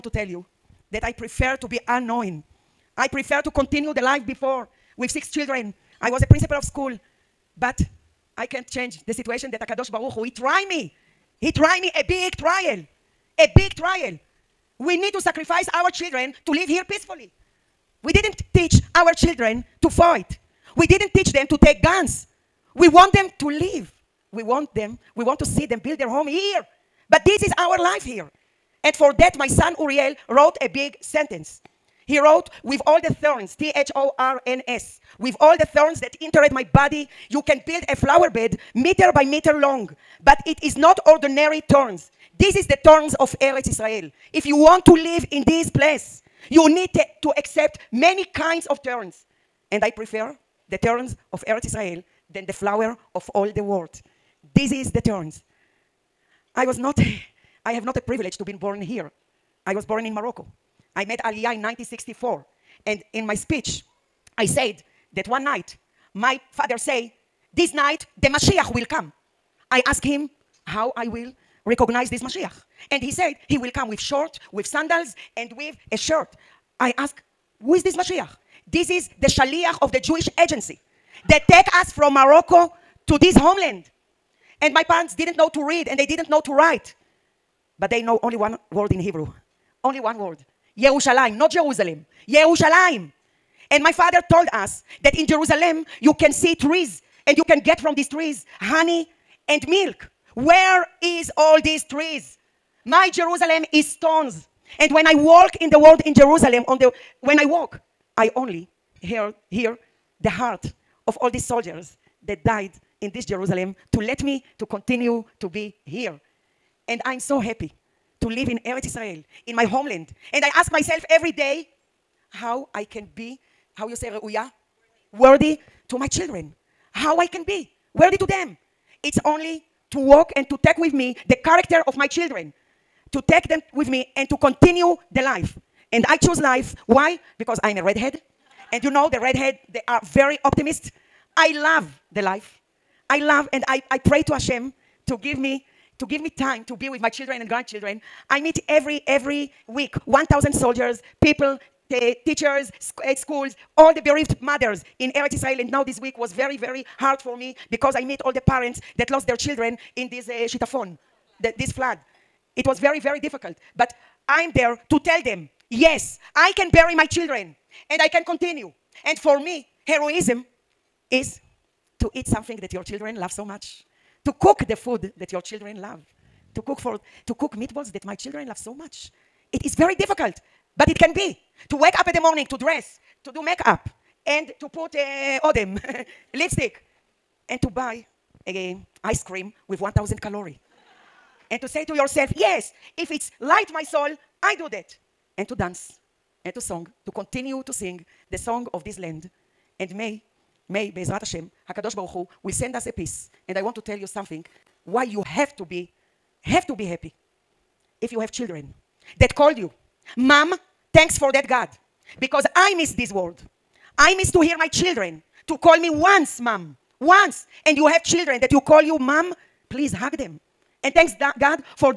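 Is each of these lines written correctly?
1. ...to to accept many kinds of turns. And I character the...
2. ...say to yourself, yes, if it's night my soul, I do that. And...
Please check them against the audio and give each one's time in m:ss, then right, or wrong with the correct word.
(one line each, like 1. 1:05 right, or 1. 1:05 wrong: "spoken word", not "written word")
1. 0:46 wrong: "prefer", not "character"
2. 3:11 wrong: "light", not "night".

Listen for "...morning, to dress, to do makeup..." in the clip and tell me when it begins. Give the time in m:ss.
3:02.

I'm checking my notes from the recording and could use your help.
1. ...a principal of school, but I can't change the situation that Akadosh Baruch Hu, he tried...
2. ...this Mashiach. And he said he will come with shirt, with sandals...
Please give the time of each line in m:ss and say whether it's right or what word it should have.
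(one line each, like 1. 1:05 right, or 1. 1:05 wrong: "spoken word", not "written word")
1. 0:06 right
2. 1:12 wrong: "short", not "shirt".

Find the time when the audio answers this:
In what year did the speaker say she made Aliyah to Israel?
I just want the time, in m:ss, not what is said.
1:01.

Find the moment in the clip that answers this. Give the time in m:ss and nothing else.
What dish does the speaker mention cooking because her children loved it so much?
2:57.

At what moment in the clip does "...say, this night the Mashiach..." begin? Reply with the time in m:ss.
1:06.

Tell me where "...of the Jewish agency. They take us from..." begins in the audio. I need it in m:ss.
1:19.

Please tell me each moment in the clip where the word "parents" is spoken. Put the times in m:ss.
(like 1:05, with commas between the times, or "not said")
1:24, 2:38.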